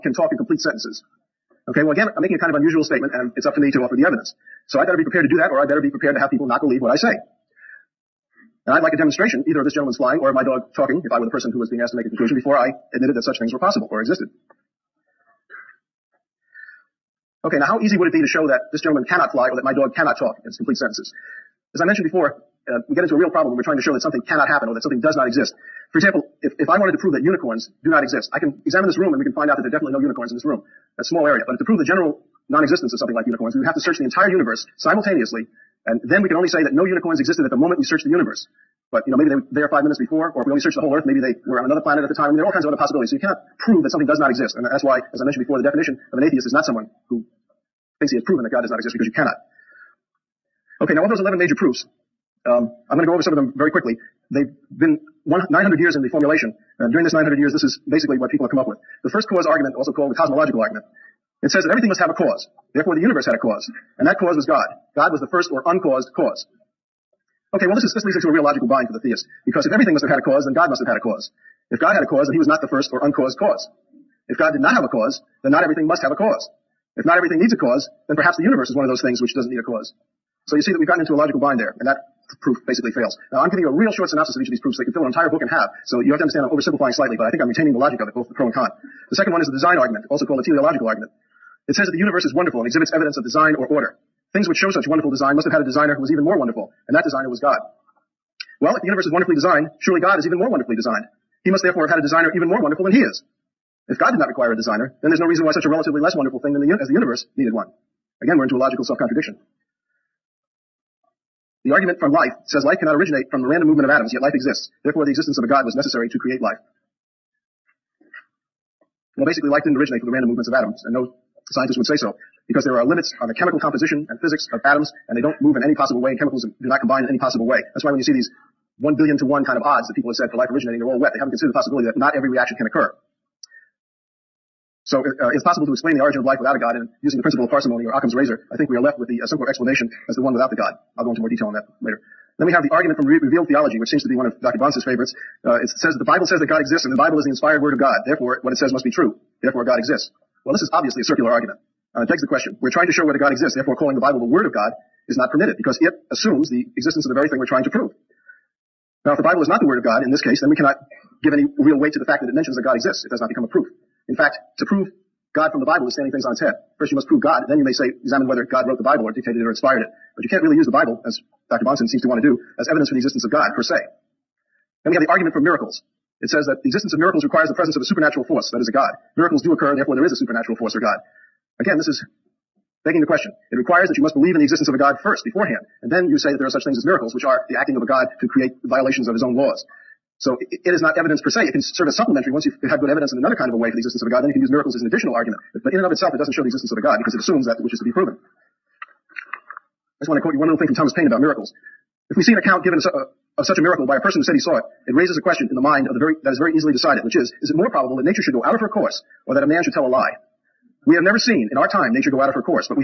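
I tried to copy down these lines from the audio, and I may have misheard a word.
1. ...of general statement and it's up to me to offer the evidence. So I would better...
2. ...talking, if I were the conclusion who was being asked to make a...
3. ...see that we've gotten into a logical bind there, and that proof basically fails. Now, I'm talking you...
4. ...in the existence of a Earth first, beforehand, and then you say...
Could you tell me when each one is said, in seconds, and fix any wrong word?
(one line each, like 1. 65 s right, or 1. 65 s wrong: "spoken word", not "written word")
1. 2 s wrong: "unusual", not "general"
2. 10 s wrong: "person", not "conclusion"
3. 80 s wrong: "giving", not "talking"
4. 184 s wrong: "God", not "Earth".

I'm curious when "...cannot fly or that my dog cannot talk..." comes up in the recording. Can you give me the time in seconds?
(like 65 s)
19 s.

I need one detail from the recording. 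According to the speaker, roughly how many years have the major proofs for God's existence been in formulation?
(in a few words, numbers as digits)
1,900 years.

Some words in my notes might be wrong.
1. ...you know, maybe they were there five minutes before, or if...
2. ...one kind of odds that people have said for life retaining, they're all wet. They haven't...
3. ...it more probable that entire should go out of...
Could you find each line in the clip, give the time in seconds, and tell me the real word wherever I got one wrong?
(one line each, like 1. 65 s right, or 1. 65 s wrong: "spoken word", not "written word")
1. 39 s right
2. 129 s wrong: "originating", not "retaining"
3. 207 s wrong: "nature", not "entire".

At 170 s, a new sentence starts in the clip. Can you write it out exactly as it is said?
But you can't really use the Bible, as Dr.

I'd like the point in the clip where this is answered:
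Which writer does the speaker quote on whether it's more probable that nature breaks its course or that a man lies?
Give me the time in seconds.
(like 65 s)
200 s.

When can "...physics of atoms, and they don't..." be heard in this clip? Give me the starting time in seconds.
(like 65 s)
124 s.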